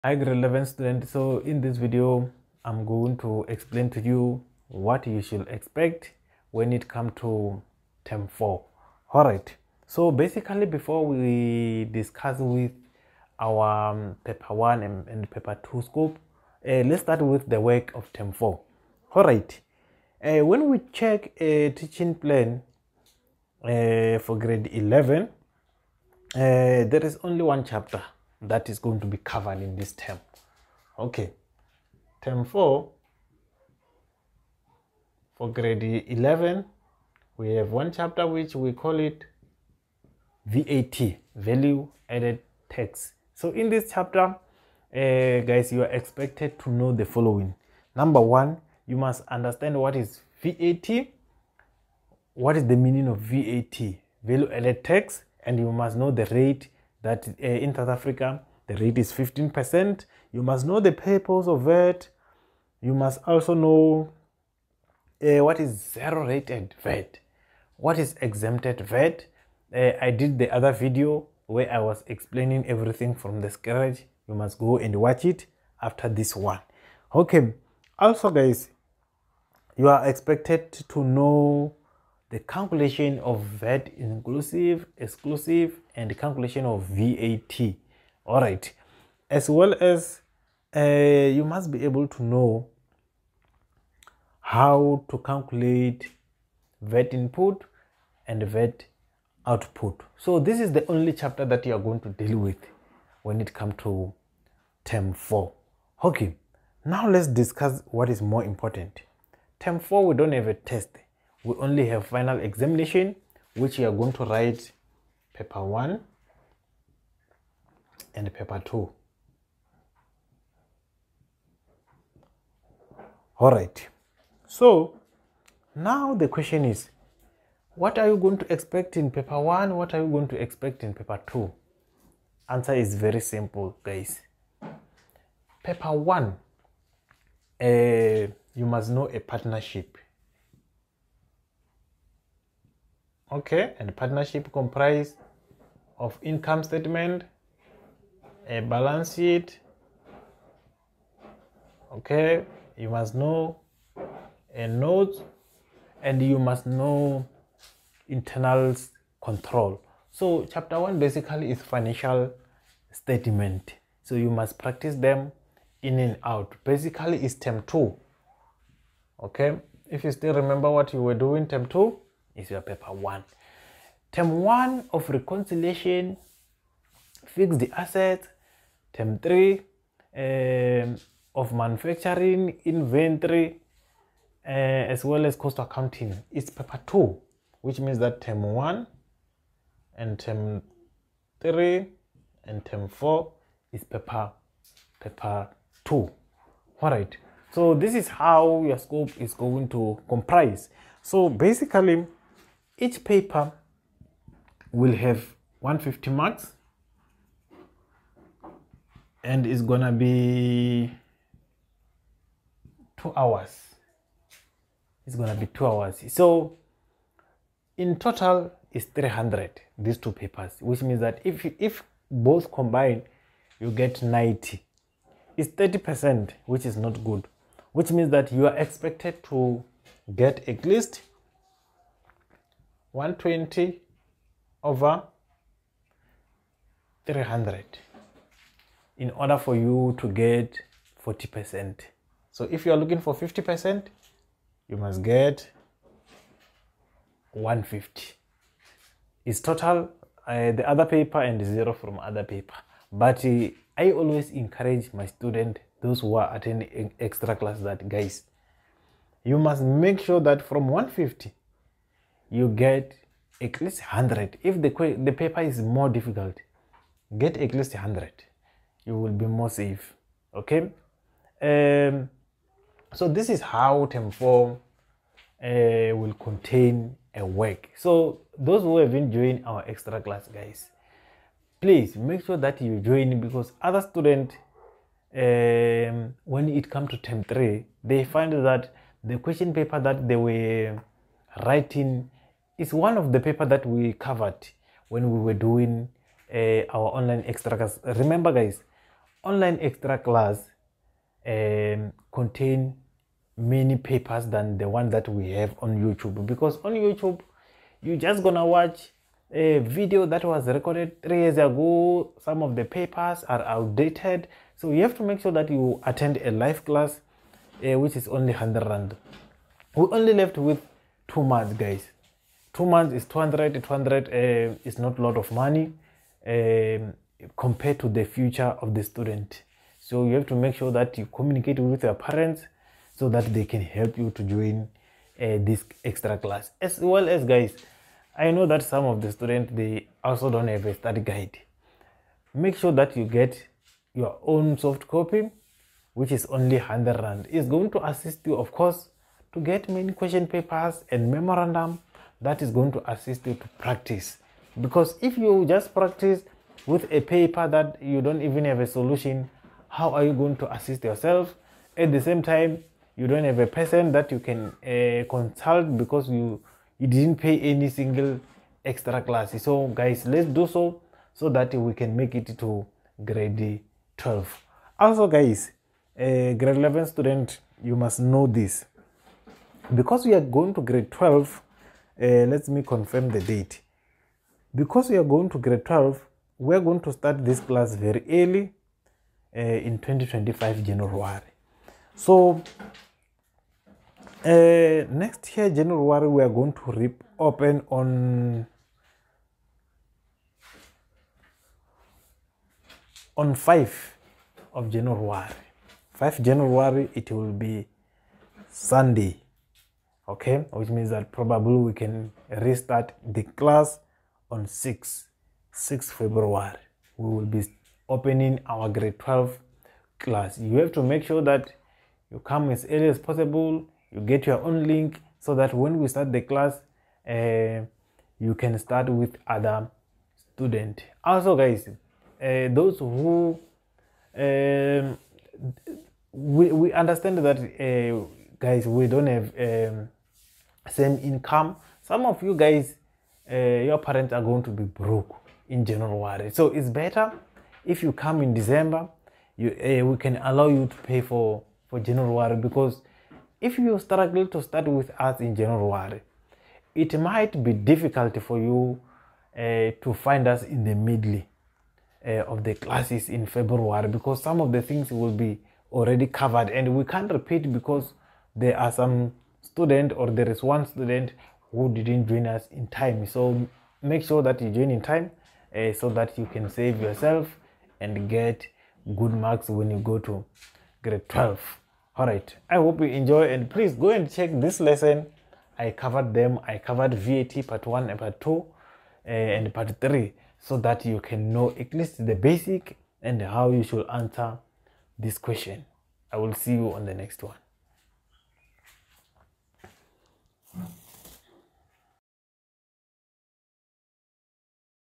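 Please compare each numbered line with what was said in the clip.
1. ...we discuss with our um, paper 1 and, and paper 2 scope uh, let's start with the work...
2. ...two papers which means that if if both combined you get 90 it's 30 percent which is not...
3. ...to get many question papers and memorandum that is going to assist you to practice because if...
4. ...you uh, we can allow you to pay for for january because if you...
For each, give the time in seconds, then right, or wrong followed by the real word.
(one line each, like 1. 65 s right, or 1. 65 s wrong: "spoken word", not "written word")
1. 11 s right
2. 219 s right
3. 349 s right
4. 449 s right.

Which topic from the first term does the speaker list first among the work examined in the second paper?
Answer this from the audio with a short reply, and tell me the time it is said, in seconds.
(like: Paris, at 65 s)
Reconciliation, at 175 s.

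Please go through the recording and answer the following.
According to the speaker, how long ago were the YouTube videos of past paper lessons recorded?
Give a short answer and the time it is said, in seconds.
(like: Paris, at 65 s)
3 years, at 311 s.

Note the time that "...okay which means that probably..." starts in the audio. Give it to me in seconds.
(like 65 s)
410 s.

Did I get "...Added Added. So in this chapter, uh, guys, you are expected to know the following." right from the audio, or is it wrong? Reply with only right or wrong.
wrong.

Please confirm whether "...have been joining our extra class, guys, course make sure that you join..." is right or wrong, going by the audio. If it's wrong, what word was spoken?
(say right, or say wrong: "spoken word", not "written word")
wrong: "please", not "course".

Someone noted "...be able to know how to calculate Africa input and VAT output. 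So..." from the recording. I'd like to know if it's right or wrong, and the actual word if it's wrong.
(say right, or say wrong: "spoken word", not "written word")
wrong: "VAT", not "Africa".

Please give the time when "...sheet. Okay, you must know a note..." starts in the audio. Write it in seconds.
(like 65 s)
149 s.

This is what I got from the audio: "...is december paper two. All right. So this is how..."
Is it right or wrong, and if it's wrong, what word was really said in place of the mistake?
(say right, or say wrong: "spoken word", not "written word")
wrong: "paper", not "december".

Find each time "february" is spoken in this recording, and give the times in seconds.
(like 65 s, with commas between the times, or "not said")
415 s, 463 s.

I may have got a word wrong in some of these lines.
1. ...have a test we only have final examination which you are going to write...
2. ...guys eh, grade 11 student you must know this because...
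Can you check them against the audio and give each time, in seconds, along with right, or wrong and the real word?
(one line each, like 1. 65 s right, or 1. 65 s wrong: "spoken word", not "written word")
1. 110 s right
2. 375 s right.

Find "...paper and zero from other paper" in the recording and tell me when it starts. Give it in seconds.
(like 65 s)
250 s.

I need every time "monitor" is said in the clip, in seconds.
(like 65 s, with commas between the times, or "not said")
not said.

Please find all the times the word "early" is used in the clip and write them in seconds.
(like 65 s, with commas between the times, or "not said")
388 s, 422 s.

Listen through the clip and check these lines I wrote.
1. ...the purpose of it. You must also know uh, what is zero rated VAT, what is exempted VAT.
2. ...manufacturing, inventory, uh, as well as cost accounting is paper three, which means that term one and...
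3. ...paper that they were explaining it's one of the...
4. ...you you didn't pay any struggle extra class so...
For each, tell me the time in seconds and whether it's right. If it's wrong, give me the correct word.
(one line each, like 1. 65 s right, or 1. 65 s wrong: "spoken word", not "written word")
1. 60 s right
2. 181 s wrong: "two", not "three"
3. 289 s wrong: "writing", not "explaining"
4. 366 s wrong: "single", not "struggle".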